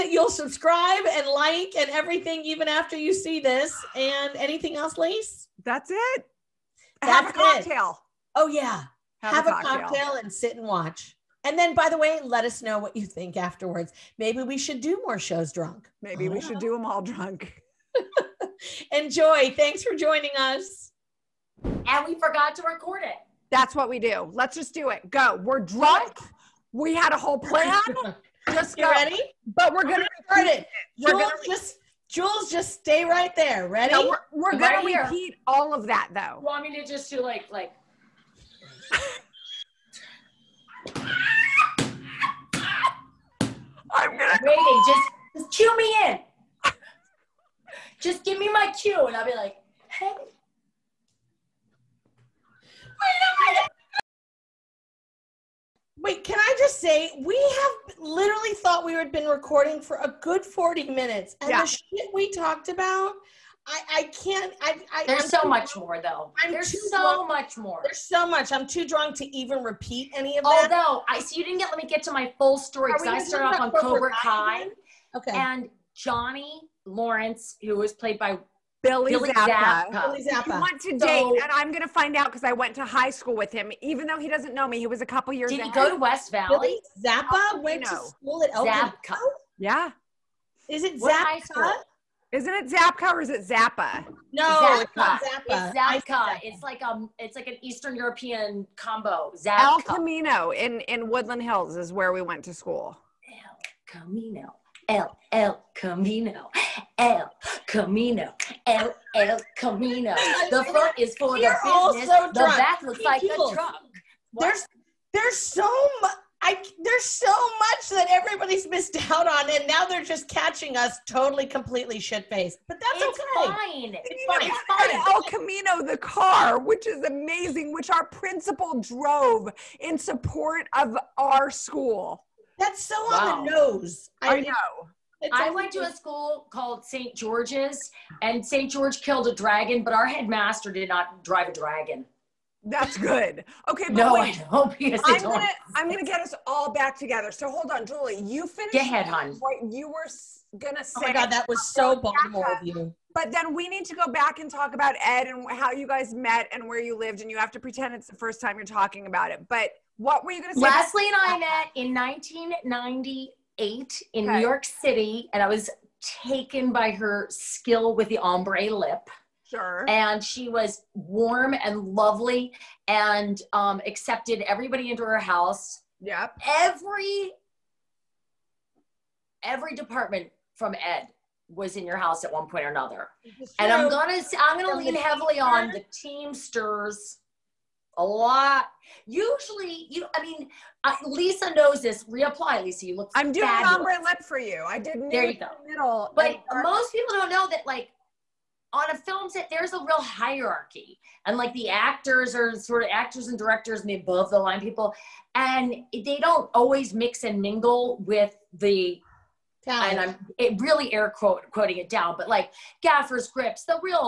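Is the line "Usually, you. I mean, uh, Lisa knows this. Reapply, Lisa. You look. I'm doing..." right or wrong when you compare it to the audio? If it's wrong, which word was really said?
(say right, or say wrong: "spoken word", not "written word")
right.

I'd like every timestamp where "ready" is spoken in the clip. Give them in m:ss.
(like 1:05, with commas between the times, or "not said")
0:28, 0:33.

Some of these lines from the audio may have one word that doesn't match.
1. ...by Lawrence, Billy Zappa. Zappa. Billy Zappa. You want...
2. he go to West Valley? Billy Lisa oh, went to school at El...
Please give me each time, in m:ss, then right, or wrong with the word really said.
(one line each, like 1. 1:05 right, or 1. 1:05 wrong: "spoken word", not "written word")
1. 1:18 wrong: "Billy", not "Lawrence"
2. 1:25 wrong: "Zappa", not "Lisa".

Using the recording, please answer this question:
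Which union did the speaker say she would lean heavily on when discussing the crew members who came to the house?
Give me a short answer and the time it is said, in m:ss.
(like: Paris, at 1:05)
Teamsters, at 3:05.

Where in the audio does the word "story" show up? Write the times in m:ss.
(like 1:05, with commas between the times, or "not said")
1:12.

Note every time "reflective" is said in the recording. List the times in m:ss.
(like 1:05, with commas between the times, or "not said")
not said.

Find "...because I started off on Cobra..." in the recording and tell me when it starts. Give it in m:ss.
1:12.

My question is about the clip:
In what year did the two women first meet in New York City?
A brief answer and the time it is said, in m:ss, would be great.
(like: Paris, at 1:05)
1998, at 2:41.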